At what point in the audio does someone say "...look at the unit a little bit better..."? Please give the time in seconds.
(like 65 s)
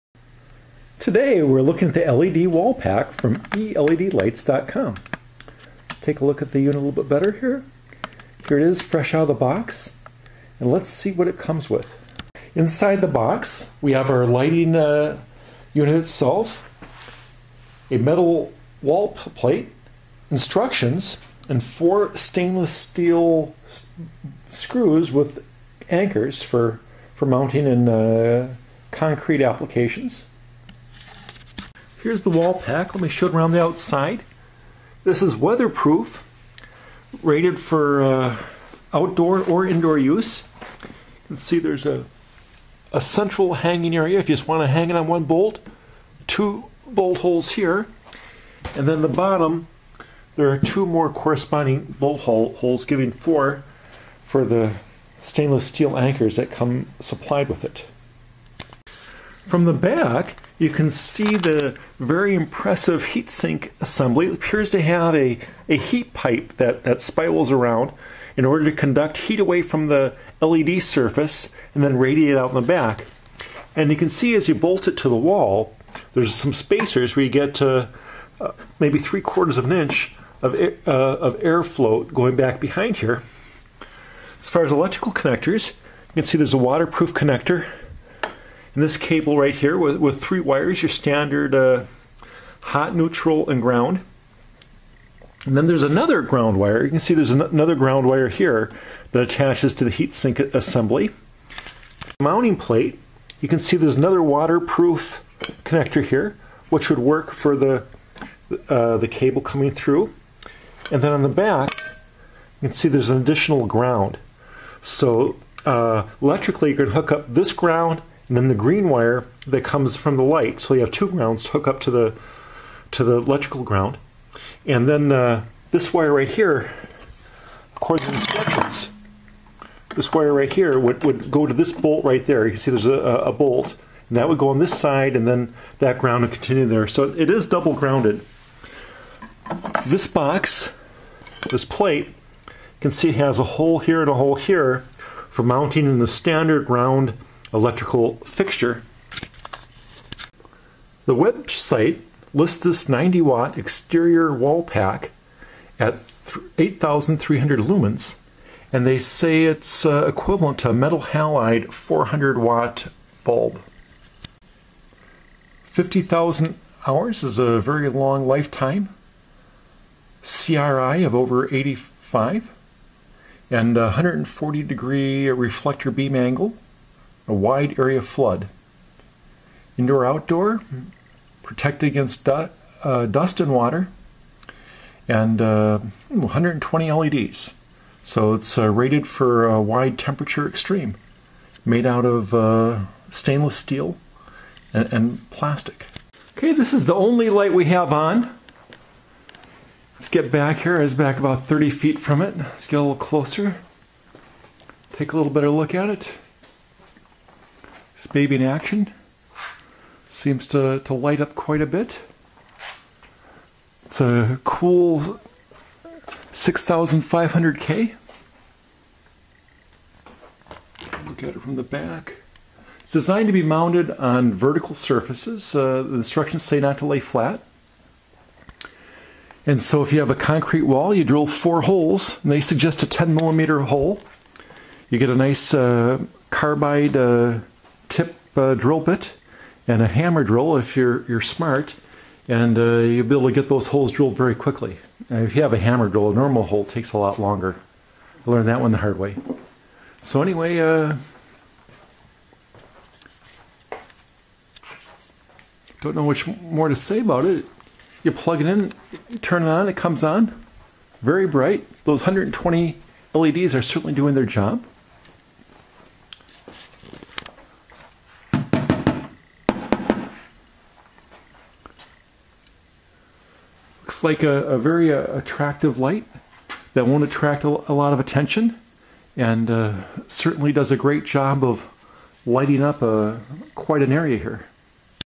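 6 s.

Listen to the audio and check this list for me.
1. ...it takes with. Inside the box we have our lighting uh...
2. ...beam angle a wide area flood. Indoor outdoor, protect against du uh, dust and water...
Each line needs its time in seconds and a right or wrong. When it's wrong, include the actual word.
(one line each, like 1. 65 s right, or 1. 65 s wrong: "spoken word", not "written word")
1. 11 s wrong: "comes", not "takes"
2. 175 s right.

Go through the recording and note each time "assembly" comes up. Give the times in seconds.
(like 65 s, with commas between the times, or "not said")
63 s, 100 s.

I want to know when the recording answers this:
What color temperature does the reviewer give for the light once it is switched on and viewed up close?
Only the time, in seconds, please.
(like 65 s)
216 s.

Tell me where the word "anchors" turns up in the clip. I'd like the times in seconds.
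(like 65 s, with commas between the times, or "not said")
25 s, 55 s.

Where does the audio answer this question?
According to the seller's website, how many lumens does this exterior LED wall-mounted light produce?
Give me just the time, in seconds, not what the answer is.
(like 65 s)
156 s.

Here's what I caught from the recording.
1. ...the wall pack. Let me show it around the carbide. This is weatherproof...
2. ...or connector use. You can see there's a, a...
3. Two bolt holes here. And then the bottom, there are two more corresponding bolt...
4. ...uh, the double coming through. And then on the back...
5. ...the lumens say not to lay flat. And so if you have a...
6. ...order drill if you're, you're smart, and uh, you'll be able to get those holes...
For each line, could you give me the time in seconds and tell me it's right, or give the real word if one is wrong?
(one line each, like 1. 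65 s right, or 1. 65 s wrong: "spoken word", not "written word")
1. 32 s wrong: "outside", not "carbide"
2. 39 s wrong: "indoor", not "connector"
3. 46 s right
4. 108 s wrong: "cable", not "double"
5. 225 s wrong: "instructions", not "lumens"
6. 239 s wrong: "hammer", not "order".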